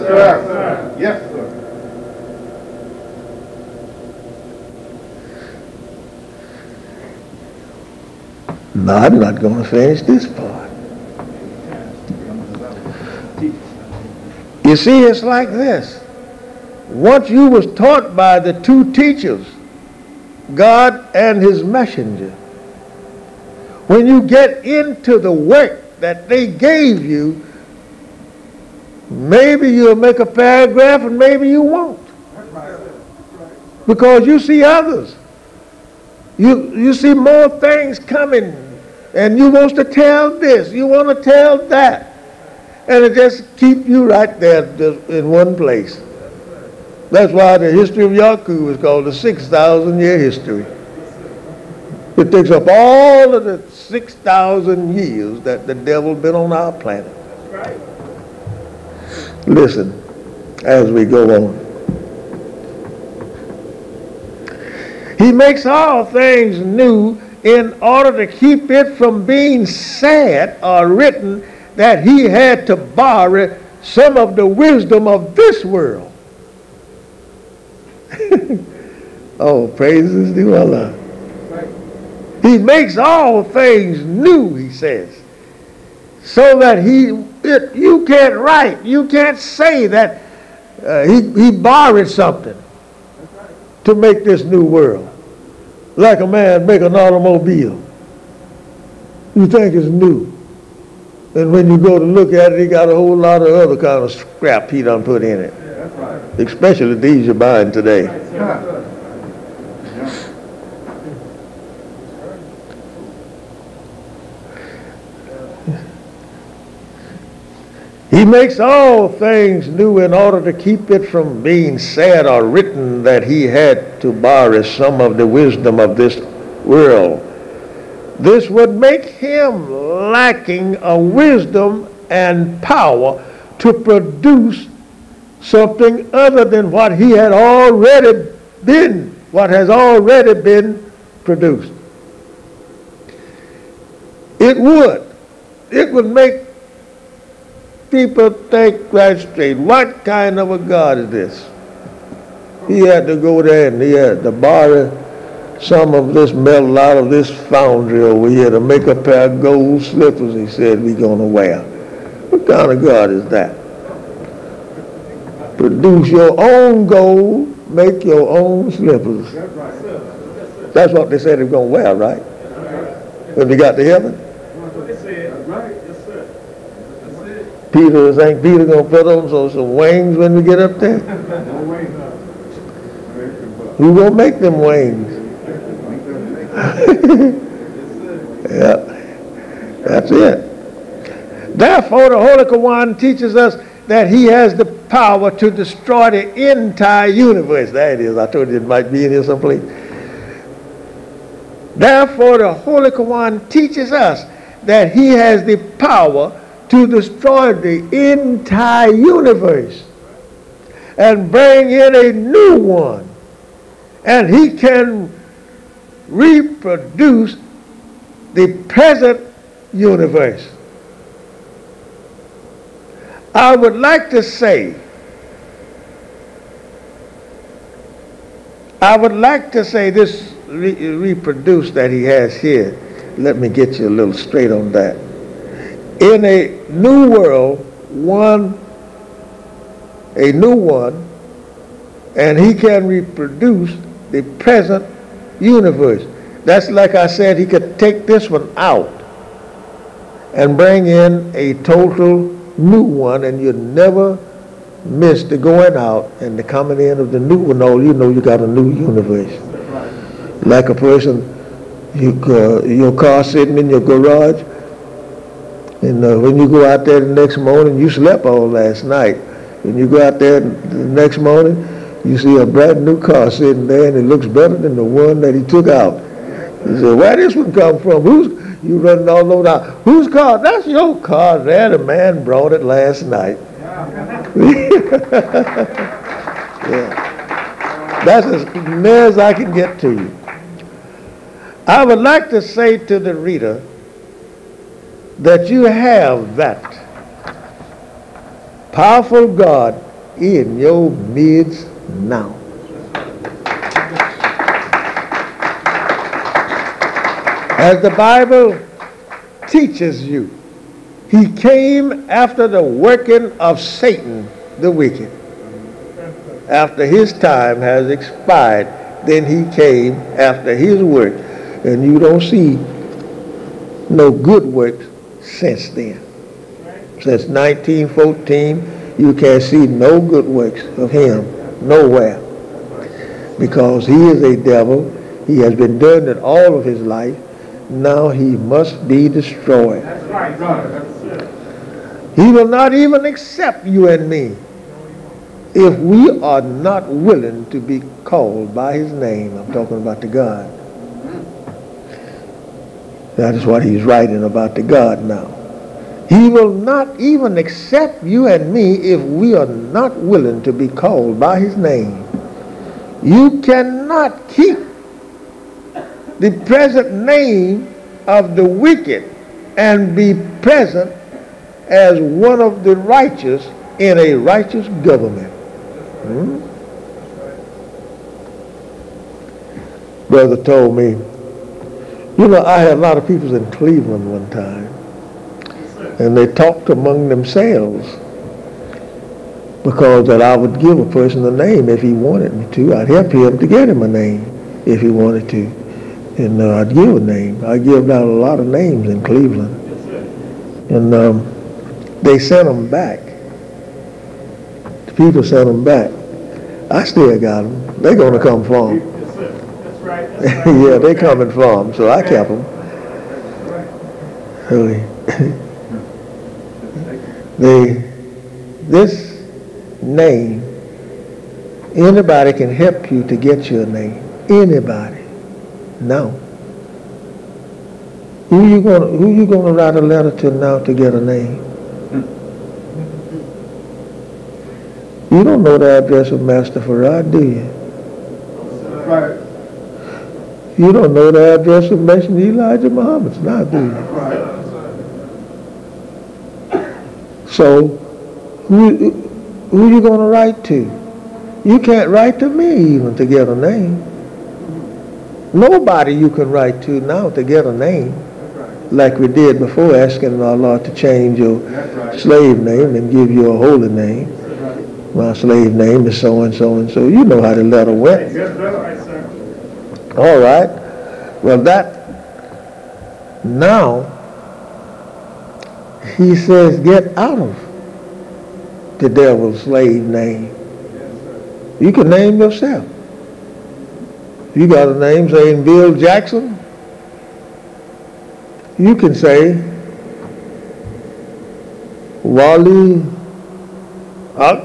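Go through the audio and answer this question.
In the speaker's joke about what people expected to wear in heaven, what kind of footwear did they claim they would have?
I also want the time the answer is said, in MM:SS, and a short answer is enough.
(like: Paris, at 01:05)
gold slippers, at 02:39.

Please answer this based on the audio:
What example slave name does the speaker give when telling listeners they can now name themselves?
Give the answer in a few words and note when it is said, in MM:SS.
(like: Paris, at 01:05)
Bill Jackson, at 08:05.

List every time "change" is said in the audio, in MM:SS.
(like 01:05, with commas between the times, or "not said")
07:40.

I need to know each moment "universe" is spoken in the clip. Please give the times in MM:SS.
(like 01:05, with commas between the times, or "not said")
03:17, 03:28, 03:39, 04:05, 04:18.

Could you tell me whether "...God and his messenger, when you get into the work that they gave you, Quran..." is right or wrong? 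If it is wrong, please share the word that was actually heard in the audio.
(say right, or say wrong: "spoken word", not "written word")
wrong: "Maybe", not "Quran".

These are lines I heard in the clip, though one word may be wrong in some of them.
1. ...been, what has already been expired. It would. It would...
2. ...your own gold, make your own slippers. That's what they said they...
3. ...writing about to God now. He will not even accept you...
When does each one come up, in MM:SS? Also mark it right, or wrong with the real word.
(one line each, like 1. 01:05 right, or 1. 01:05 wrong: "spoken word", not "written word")
1. 02:18 wrong: "produced", not "expired"
2. 02:46 right
3. 05:53 right.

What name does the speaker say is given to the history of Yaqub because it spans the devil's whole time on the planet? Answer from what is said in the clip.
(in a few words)
6,000 year history.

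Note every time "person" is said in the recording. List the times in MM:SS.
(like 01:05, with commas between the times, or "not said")
04:20, 06:30.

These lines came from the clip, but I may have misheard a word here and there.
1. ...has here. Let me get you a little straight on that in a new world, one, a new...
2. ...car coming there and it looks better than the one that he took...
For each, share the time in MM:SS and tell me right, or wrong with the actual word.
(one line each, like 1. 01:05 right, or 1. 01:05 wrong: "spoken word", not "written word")
1. 03:52 right
2. 04:32 wrong: "sitting", not "coming".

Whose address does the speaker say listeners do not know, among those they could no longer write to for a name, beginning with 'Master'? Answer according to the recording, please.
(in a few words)
Master Farad.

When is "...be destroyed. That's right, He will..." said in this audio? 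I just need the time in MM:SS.
05:38.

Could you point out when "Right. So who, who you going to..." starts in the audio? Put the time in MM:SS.
07:26.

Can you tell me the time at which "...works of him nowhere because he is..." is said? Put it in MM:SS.
05:30.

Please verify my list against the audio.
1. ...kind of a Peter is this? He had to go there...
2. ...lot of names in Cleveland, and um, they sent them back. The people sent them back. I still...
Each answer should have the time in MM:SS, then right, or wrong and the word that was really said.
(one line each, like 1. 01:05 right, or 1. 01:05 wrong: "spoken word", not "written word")
1. 02:30 wrong: "God", not "Peter"
2. 06:38 right.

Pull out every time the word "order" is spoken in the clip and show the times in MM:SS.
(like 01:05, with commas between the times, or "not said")
01:07, 02:00.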